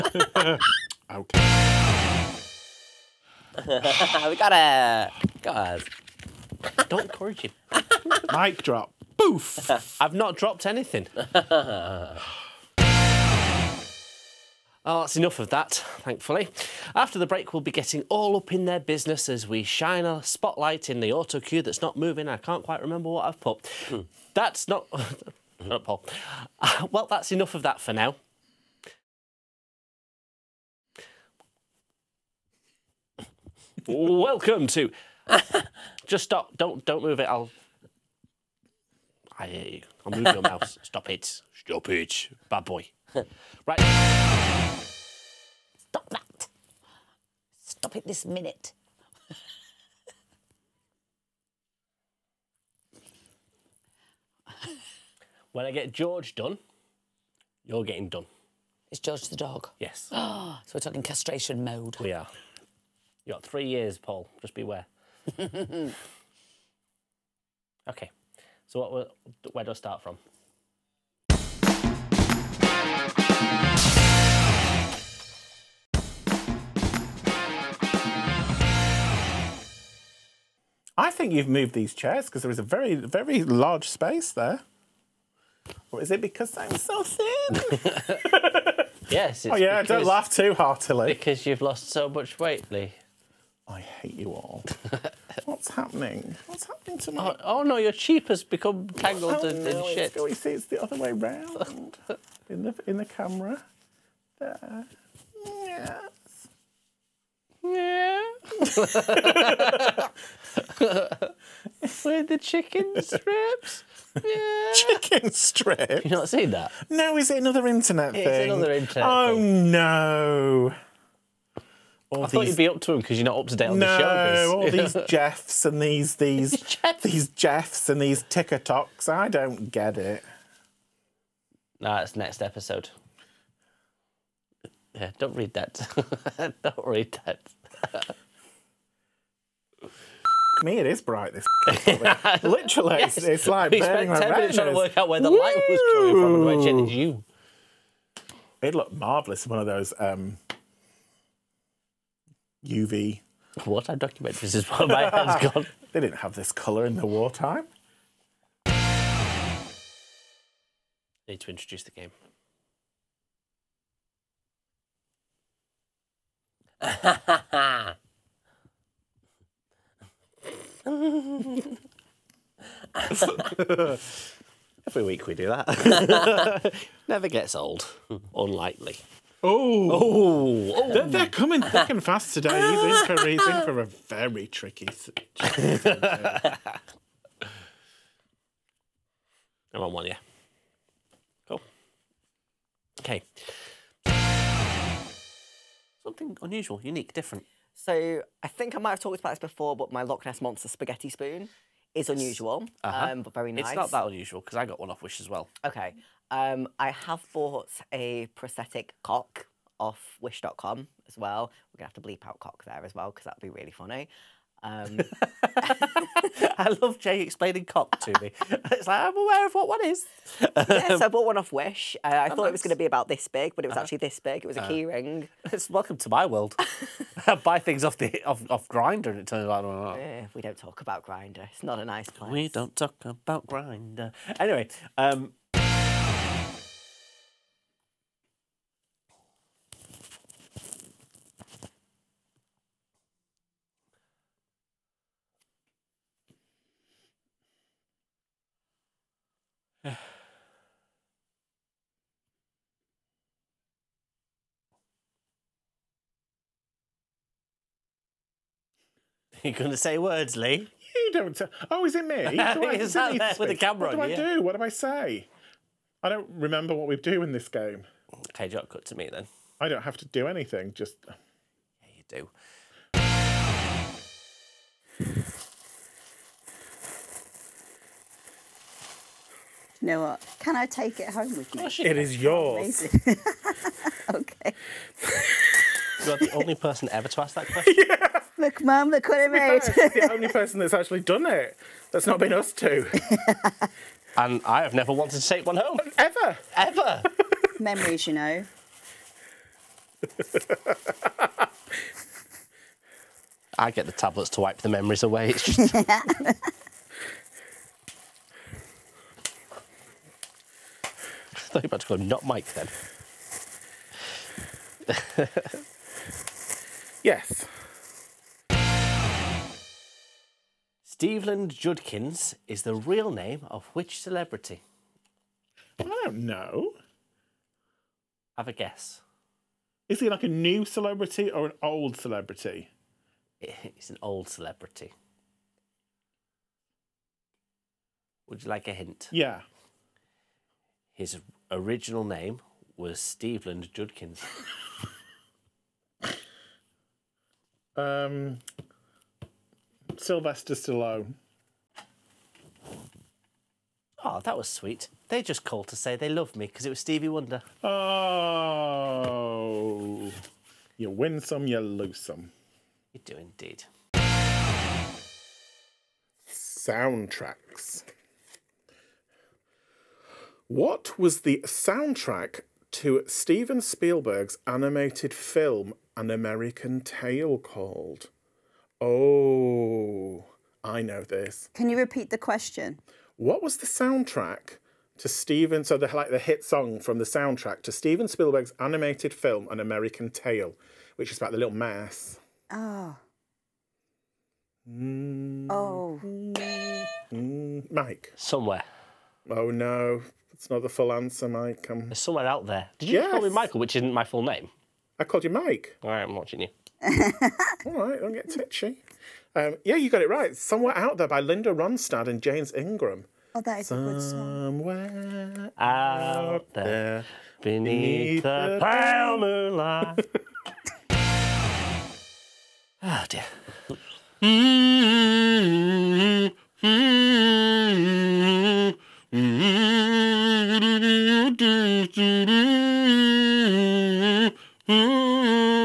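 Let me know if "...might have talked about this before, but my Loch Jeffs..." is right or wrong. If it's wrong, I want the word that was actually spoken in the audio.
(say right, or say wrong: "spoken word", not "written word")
wrong: "Ness", not "Jeffs".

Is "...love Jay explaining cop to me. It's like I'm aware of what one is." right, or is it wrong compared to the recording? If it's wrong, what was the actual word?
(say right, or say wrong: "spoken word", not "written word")
right.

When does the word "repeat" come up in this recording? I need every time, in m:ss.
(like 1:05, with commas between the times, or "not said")
6:21.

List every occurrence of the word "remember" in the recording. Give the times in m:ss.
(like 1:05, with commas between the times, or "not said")
0:22, 4:26.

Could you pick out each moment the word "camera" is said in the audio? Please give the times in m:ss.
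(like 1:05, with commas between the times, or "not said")
1:43, 4:23.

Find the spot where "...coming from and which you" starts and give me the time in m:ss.
2:25.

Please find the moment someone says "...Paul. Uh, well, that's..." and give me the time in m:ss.
0:25.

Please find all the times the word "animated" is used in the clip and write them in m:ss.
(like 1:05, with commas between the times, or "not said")
6:14, 6:28.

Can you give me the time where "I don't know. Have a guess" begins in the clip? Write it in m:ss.
5:25.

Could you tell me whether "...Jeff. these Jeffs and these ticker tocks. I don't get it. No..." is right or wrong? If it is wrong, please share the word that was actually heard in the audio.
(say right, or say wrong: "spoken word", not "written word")
right.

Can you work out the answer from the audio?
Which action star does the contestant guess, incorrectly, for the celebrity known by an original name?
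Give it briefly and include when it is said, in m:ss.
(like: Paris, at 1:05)
Sylvester Stallone, at 5:49.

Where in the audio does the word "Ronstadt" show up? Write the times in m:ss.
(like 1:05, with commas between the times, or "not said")
6:51.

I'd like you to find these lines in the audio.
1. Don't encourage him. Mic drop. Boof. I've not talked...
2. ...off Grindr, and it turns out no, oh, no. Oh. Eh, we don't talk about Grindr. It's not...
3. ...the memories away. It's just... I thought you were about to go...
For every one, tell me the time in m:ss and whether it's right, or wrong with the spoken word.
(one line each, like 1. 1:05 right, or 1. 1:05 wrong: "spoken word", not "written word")
1. 0:06 wrong: "dropped", not "talked"
2. 3:48 right
3. 5:04 right.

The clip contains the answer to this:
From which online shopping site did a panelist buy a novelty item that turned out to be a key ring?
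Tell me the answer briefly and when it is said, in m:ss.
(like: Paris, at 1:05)
Wish.com, at 3:30.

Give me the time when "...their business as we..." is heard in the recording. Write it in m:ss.
0:18.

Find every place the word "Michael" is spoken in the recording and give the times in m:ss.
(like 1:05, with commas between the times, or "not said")
6:43.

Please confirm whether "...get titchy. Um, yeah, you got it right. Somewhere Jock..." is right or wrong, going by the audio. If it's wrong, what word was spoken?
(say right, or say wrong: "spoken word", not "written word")
wrong: "Out", not "Jock".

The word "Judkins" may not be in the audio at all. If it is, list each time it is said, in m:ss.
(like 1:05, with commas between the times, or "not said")
5:21, 5:43.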